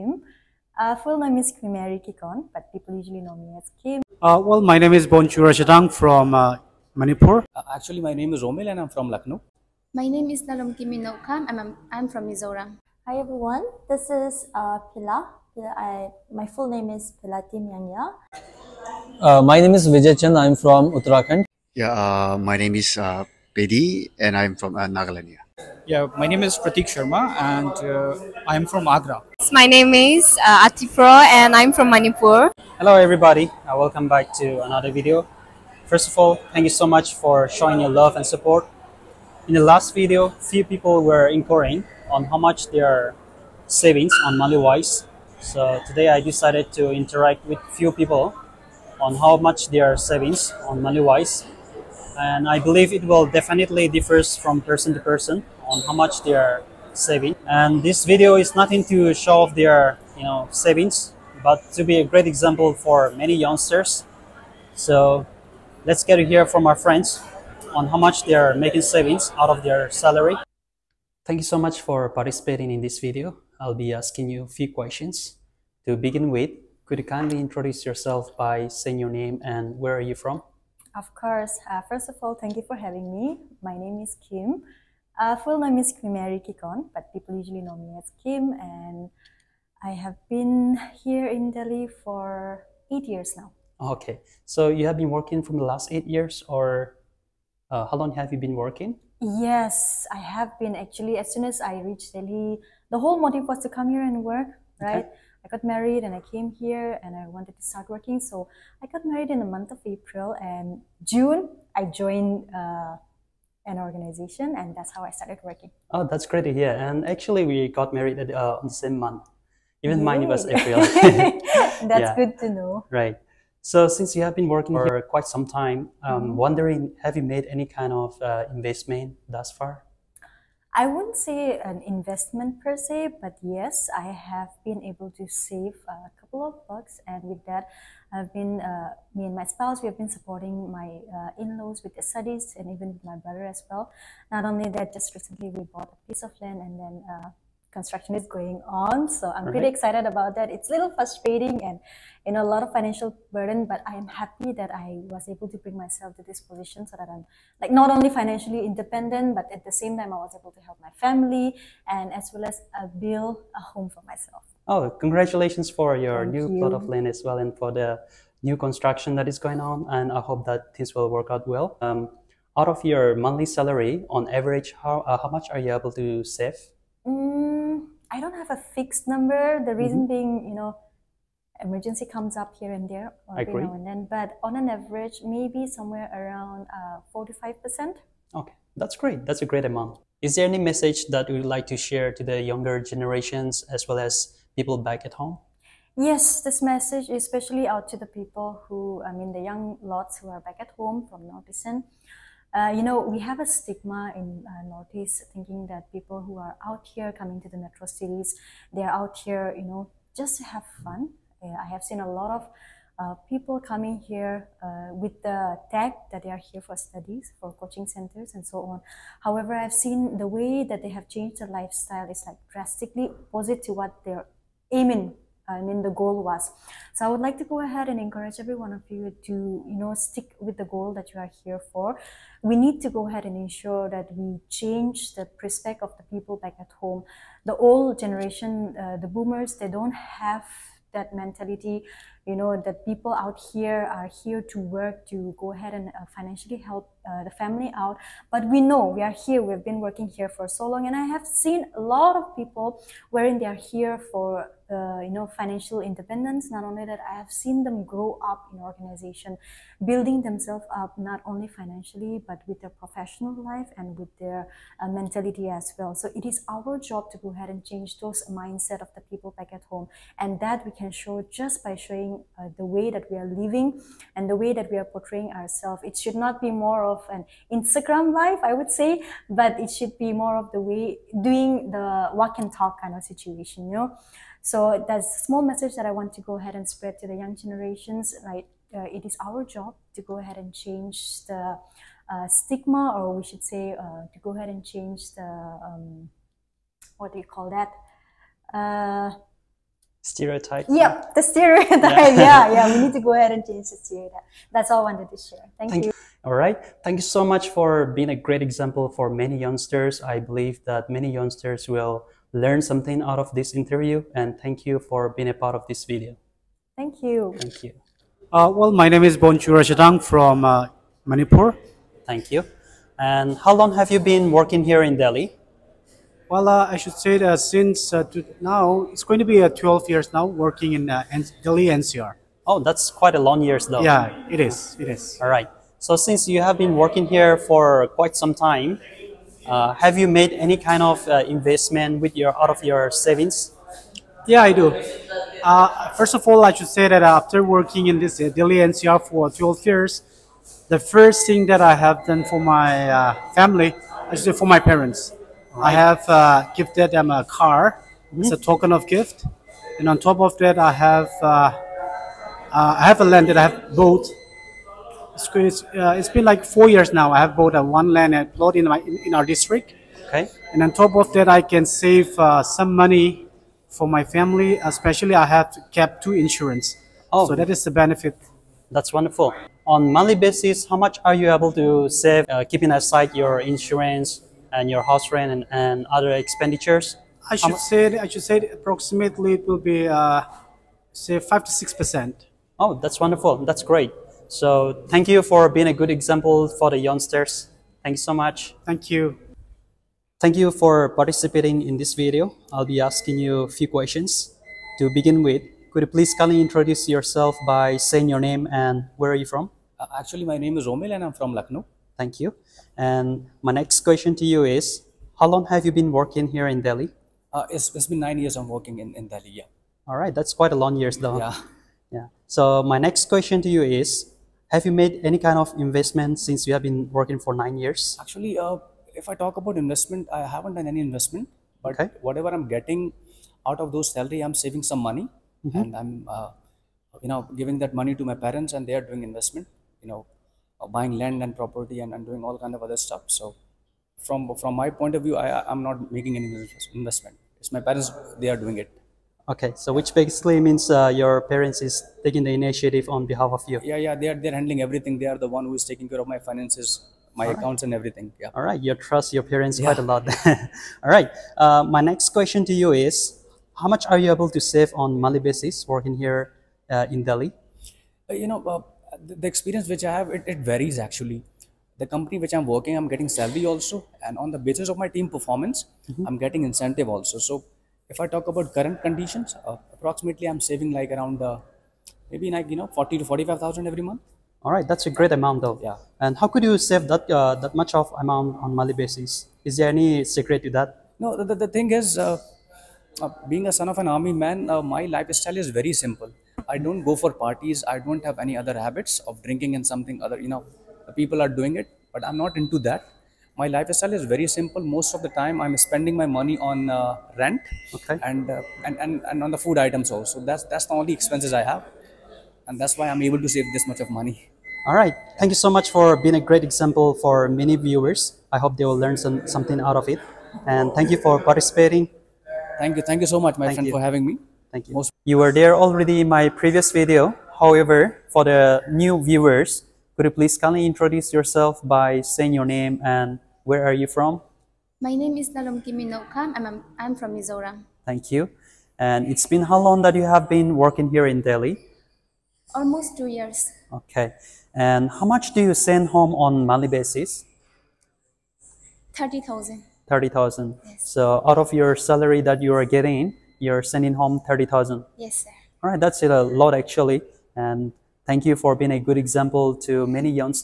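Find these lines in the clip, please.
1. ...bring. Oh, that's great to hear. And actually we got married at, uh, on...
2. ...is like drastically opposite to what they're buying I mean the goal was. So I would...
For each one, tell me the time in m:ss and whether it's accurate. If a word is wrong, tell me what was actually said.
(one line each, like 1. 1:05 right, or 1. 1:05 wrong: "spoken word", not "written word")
1. 1:55 wrong: "working", not "bring"
2. 3:42 wrong: "aiming", not "buying".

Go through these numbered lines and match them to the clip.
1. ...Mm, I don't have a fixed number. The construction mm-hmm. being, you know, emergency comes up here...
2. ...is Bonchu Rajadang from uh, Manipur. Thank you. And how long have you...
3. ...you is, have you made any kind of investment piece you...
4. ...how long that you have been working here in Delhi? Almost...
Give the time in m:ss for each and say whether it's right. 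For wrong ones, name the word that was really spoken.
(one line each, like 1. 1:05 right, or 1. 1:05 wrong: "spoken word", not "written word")
1. 2:57 wrong: "reason", not "construction"
2. 5:19 right
3. 7:03 wrong: "since", not "piece"
4. 8:59 right.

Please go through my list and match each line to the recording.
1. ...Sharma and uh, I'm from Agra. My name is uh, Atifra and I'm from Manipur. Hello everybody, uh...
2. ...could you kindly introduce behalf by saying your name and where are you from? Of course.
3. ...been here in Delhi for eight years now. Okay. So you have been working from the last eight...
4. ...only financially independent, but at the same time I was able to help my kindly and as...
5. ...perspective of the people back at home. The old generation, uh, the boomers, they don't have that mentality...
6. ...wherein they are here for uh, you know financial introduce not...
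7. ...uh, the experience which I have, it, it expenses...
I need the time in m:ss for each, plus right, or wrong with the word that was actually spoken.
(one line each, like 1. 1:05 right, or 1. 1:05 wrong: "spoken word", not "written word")
1. 0:26 right
2. 1:16 wrong: "yourself", not "behalf"
3. 1:30 right
4. 2:37 wrong: "family", not "kindly"
5. 3:55 right
6. 4:13 wrong: "independence", not "introduce"
7. 7:48 wrong: "varies", not "expenses".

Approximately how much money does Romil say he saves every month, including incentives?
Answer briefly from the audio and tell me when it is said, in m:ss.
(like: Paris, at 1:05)
40,000 to 45,000, at 8:02.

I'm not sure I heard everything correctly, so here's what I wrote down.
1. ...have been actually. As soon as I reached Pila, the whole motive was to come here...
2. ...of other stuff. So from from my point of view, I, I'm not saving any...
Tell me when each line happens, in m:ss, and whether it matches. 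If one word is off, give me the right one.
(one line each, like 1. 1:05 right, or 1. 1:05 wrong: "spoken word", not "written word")
1. 1:40 wrong: "Delhi", not "Pila"
2. 7:22 wrong: "making", not "saving".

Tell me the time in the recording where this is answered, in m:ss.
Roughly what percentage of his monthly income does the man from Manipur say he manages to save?
6:31.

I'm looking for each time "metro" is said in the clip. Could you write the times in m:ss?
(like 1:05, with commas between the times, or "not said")
3:27.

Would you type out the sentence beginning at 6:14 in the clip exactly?
Especially, I have kept two insurance.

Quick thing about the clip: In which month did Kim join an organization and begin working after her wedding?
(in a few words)
June.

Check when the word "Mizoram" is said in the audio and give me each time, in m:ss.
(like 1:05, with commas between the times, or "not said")
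0:12, 8:57.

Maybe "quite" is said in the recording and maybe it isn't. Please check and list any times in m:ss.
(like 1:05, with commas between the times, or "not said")
2:05, 5:32, 5:37, 7:00, 7:39.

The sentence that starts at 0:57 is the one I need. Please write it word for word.
And this video is nothing to show off their you know savings, but to be a great example for many youngsters.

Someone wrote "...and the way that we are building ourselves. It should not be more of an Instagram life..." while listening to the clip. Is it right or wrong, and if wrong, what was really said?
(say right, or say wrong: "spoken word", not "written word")
wrong: "portraying", not "building".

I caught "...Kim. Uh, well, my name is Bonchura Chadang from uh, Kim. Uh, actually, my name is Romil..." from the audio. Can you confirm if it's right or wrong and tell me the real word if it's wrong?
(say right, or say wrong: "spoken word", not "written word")
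wrong: "Manipur", not "Kim".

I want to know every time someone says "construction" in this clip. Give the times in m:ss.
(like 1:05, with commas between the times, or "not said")
2:27, 2:48.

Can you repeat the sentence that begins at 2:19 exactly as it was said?
We have been supporting my uh, in-laws with the studies, and even with my brother as well.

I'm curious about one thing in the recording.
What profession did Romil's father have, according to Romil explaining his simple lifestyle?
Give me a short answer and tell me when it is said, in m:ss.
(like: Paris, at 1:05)
Army man, at 8:13.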